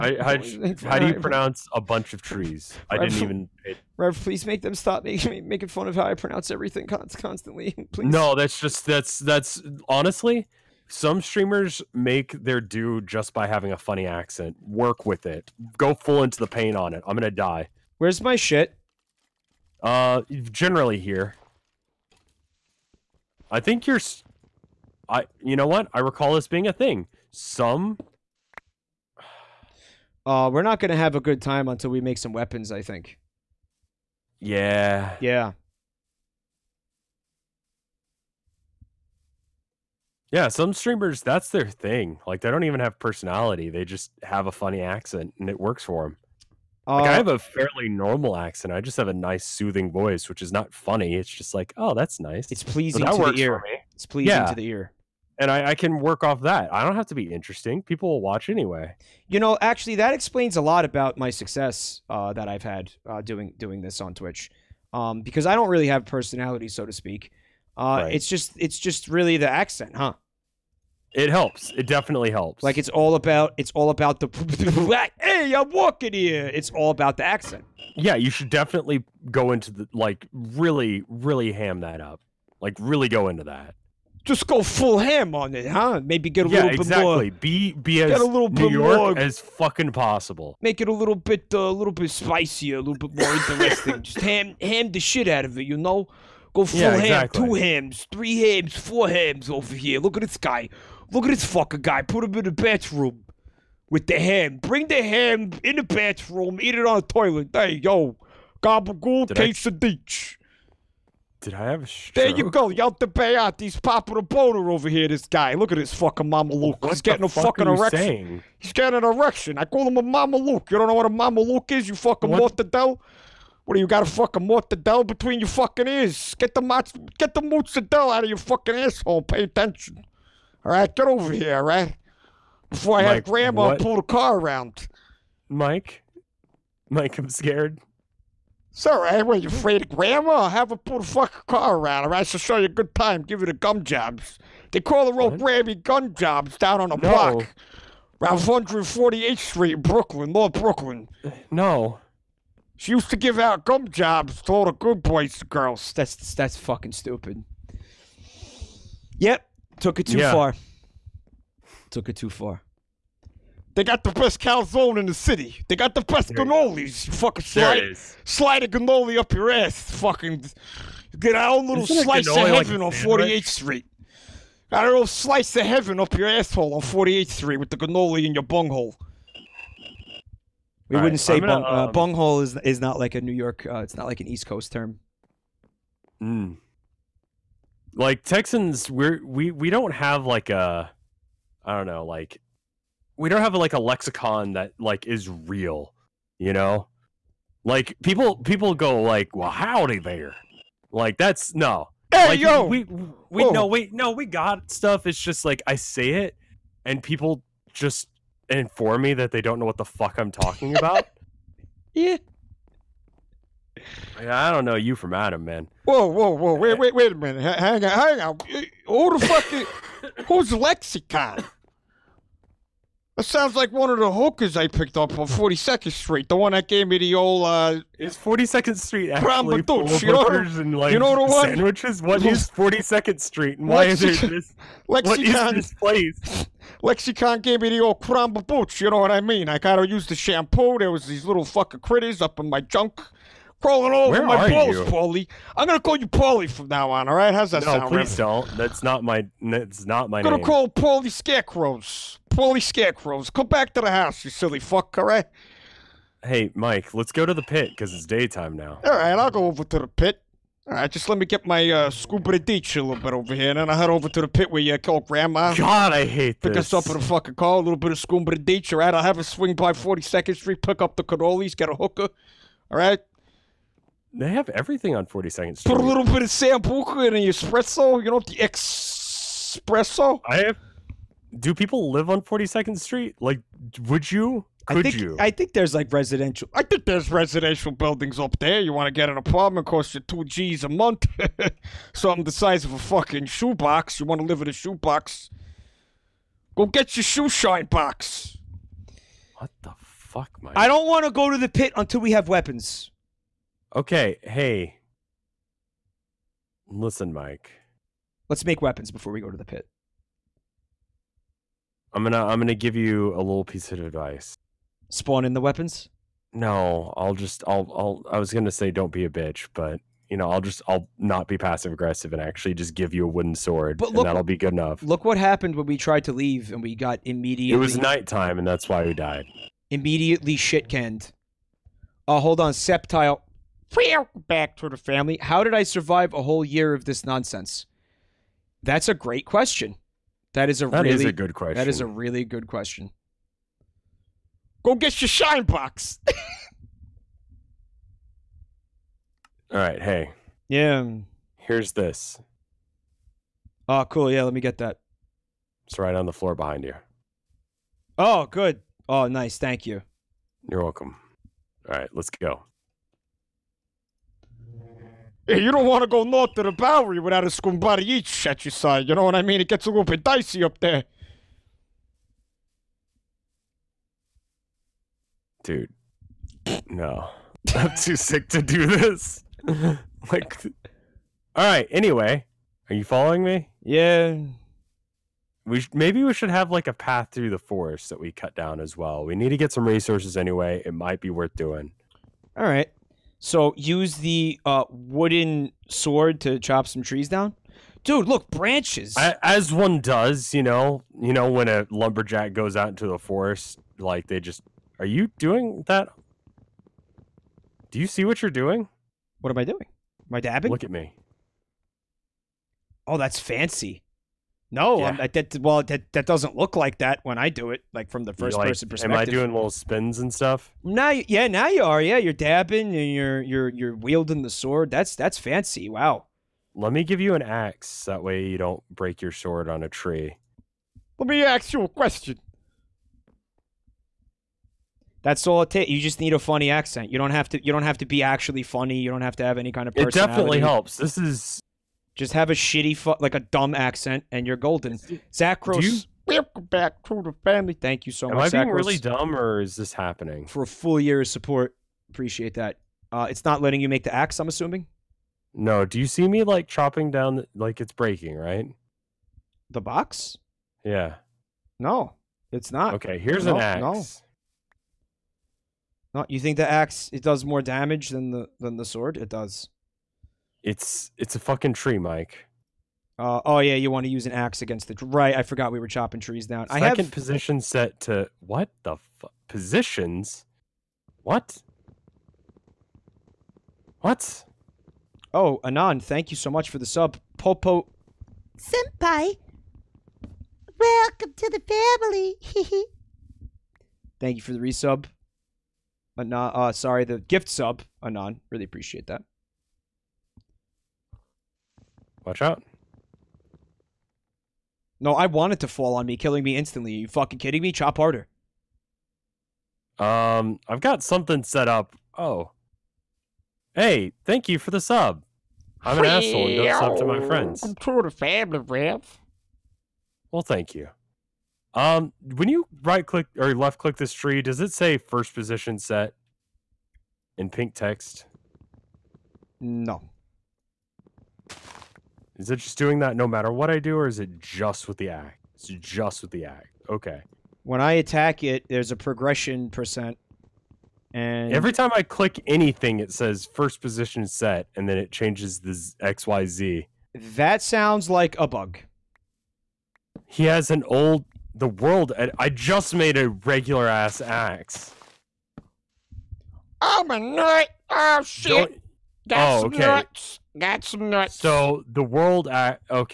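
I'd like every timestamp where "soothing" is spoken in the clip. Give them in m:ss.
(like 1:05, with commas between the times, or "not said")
0:49.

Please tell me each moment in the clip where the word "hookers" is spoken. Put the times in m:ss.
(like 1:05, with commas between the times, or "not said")
3:44, 4:31.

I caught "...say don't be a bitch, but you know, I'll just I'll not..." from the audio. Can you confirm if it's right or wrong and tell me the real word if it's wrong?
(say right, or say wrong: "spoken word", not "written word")
right.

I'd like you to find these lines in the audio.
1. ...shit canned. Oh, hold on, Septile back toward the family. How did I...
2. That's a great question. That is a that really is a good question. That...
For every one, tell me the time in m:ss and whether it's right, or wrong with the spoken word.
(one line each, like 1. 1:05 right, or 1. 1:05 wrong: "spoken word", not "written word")
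1. 5:30 right
2. 5:38 right.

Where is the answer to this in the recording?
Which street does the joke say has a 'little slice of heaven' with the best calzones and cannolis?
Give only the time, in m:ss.
2:52.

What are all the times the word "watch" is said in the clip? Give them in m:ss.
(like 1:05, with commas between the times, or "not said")
0:58, 8:22.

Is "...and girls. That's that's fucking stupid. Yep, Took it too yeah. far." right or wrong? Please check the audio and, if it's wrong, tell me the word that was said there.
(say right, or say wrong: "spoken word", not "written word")
right.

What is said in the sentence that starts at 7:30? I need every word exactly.
For a full year of support, appreciate that.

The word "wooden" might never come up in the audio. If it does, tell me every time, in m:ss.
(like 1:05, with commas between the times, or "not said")
5:23, 6:34.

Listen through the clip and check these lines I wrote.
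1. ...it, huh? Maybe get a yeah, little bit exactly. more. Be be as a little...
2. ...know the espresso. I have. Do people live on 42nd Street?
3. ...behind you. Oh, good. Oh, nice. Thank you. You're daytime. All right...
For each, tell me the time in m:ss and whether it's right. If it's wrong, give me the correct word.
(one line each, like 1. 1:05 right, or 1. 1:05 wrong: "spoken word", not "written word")
1. 1:25 right
2. 4:38 right
3. 5:56 wrong: "welcome", not "daytime".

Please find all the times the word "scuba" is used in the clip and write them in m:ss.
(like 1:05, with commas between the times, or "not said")
4:21, 4:27.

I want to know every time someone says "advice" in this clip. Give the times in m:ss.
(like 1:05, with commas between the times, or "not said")
5:13.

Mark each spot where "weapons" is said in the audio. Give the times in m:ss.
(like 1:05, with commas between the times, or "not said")
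0:32, 5:02, 5:08, 5:15.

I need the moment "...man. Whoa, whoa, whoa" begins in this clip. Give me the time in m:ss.
3:35.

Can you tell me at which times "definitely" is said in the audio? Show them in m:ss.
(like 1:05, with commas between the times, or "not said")
1:11, 1:18, 7:19.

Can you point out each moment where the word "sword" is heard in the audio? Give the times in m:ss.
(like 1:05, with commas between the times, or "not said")
5:23, 6:35, 7:04, 7:09, 7:48.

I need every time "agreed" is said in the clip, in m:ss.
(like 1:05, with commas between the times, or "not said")
not said.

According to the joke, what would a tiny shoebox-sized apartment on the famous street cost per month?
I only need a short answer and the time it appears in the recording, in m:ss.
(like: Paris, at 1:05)
2 G's, at 4:49.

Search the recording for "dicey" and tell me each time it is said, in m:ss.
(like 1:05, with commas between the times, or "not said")
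6:10.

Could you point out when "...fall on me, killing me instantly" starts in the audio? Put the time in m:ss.
8:25.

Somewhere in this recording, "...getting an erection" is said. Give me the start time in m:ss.
1:58.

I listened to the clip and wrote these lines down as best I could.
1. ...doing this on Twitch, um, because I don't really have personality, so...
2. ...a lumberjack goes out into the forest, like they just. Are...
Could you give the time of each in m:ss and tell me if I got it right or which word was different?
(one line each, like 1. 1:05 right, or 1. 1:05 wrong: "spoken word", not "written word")
1. 1:03 right
2. 6:41 right.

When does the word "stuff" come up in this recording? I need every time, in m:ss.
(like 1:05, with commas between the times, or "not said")
3:24, 7:00.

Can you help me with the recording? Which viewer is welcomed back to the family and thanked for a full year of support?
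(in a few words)
Zach Gross.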